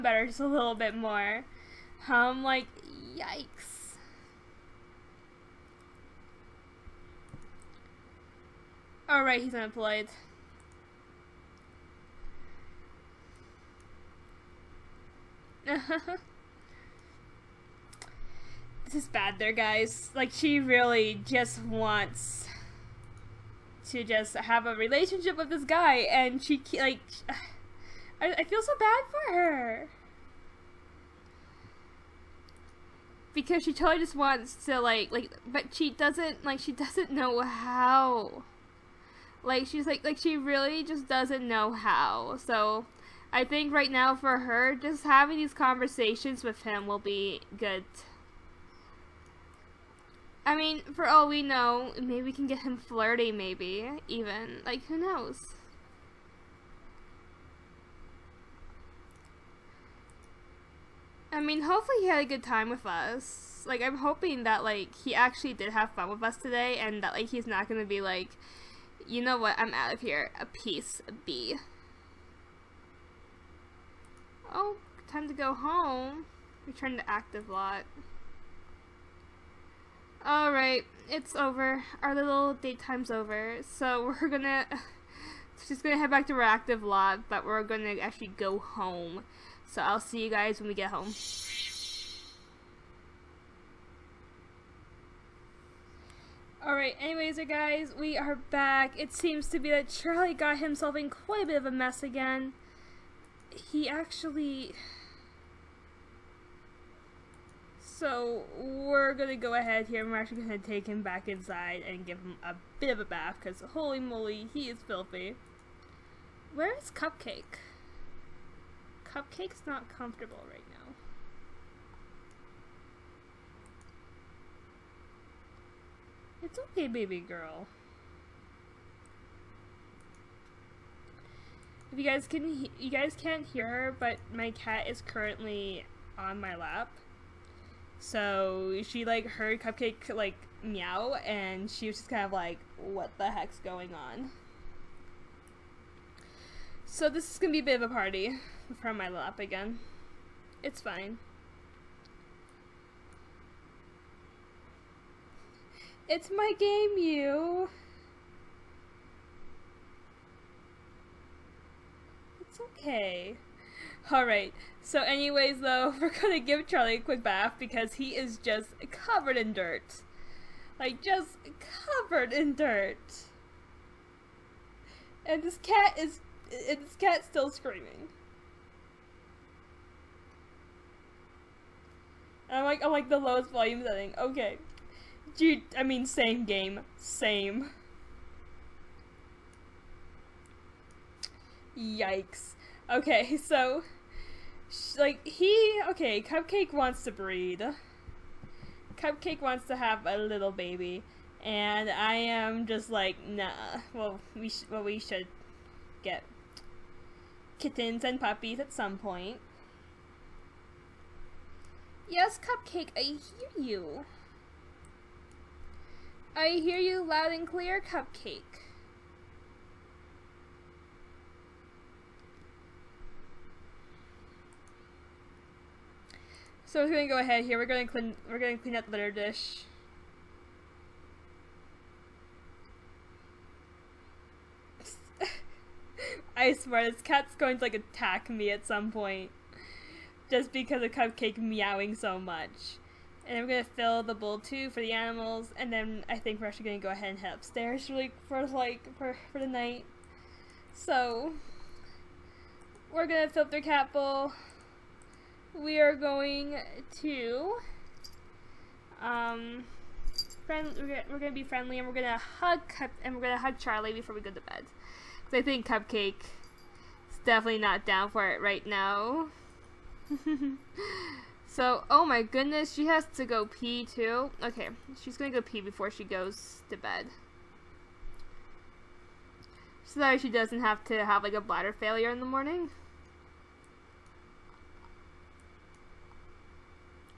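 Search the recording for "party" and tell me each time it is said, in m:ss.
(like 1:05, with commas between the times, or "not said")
2:27.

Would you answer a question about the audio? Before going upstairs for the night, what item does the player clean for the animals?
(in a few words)
Litter dish.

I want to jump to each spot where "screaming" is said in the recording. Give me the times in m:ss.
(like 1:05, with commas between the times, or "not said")
2:57.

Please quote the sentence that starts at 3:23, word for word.
Well, we sh- well we should get kittens and puppies at some point.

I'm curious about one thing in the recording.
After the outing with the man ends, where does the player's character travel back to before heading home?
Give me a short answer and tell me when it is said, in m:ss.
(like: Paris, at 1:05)
Reactive lot, at 1:26.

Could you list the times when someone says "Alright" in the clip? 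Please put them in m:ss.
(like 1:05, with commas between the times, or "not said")
0:09, 1:20, 1:36, 2:44.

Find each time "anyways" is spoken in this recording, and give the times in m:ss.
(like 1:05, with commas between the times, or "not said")
1:37, 2:45.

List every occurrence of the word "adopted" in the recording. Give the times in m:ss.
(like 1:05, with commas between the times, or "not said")
not said.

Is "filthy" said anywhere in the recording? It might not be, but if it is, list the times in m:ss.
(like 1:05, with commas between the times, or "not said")
1:54.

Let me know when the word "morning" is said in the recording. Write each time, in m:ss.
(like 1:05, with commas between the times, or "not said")
4:42.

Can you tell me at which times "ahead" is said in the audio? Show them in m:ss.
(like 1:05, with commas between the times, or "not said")
1:49, 3:47, 4:06.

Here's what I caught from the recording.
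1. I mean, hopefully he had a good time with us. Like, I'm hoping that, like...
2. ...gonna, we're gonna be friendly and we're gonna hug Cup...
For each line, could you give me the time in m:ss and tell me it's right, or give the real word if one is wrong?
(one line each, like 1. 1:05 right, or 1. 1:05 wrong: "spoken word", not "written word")
1. 1:01 right
2. 4:20 right.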